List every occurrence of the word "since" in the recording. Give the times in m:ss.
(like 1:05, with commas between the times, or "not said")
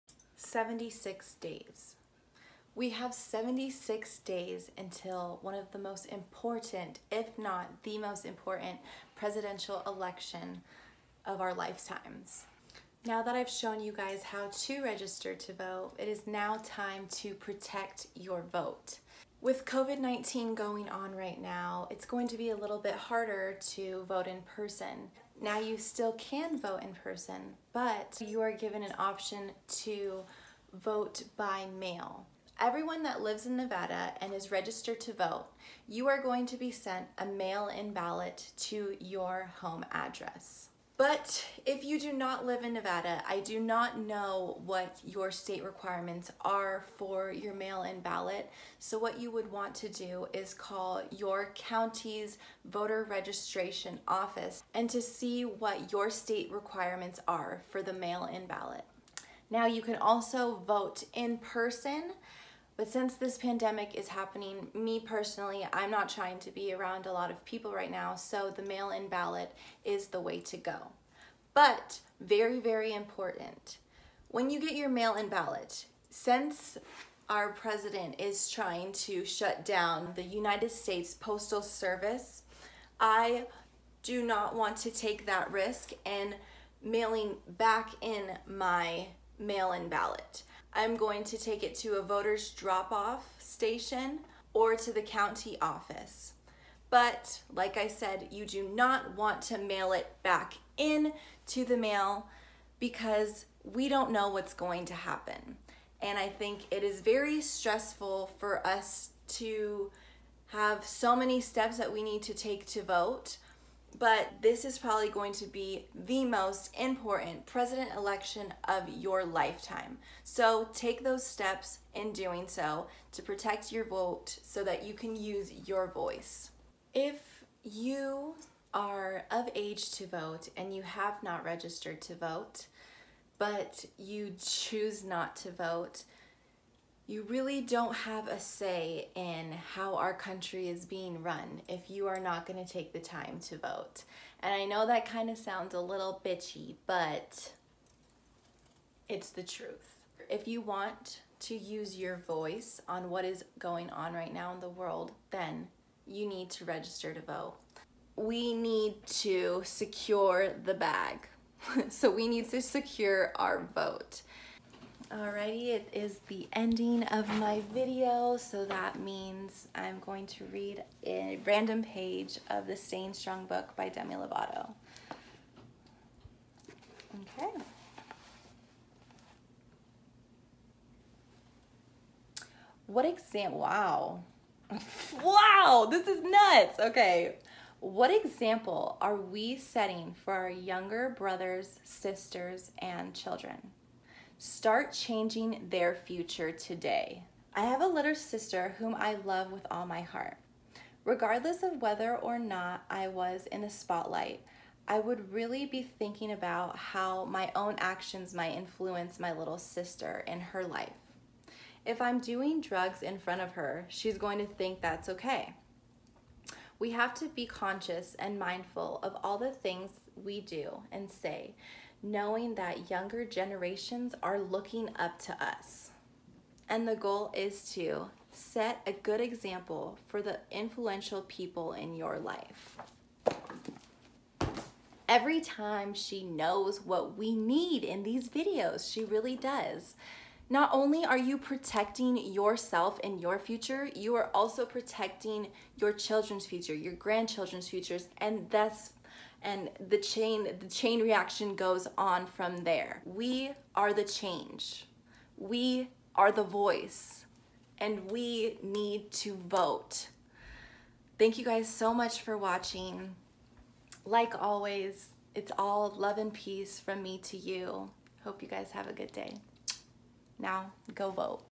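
1:02, 1:16.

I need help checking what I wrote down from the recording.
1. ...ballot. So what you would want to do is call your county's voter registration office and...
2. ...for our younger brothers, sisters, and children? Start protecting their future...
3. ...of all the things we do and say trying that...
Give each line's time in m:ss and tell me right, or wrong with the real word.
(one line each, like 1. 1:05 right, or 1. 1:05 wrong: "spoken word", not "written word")
1. 0:48 right
2. 3:10 wrong: "changing", not "protecting"
3. 3:39 wrong: "knowing", not "trying".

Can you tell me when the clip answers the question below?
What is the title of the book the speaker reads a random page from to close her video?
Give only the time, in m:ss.
2:52.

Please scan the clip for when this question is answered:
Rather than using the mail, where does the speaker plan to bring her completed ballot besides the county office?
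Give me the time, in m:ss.
1:32.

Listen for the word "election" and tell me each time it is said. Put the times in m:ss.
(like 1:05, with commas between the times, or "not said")
0:09, 1:57.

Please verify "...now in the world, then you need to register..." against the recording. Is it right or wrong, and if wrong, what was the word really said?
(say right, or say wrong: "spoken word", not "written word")
right.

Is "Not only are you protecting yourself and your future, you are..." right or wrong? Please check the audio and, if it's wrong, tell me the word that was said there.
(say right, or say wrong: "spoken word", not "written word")
right.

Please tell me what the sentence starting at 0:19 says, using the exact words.
With COVID-19 going on right now, it's going to be a little bit harder to vote in person.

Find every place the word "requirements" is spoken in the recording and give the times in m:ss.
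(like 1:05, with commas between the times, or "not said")
0:45, 0:56.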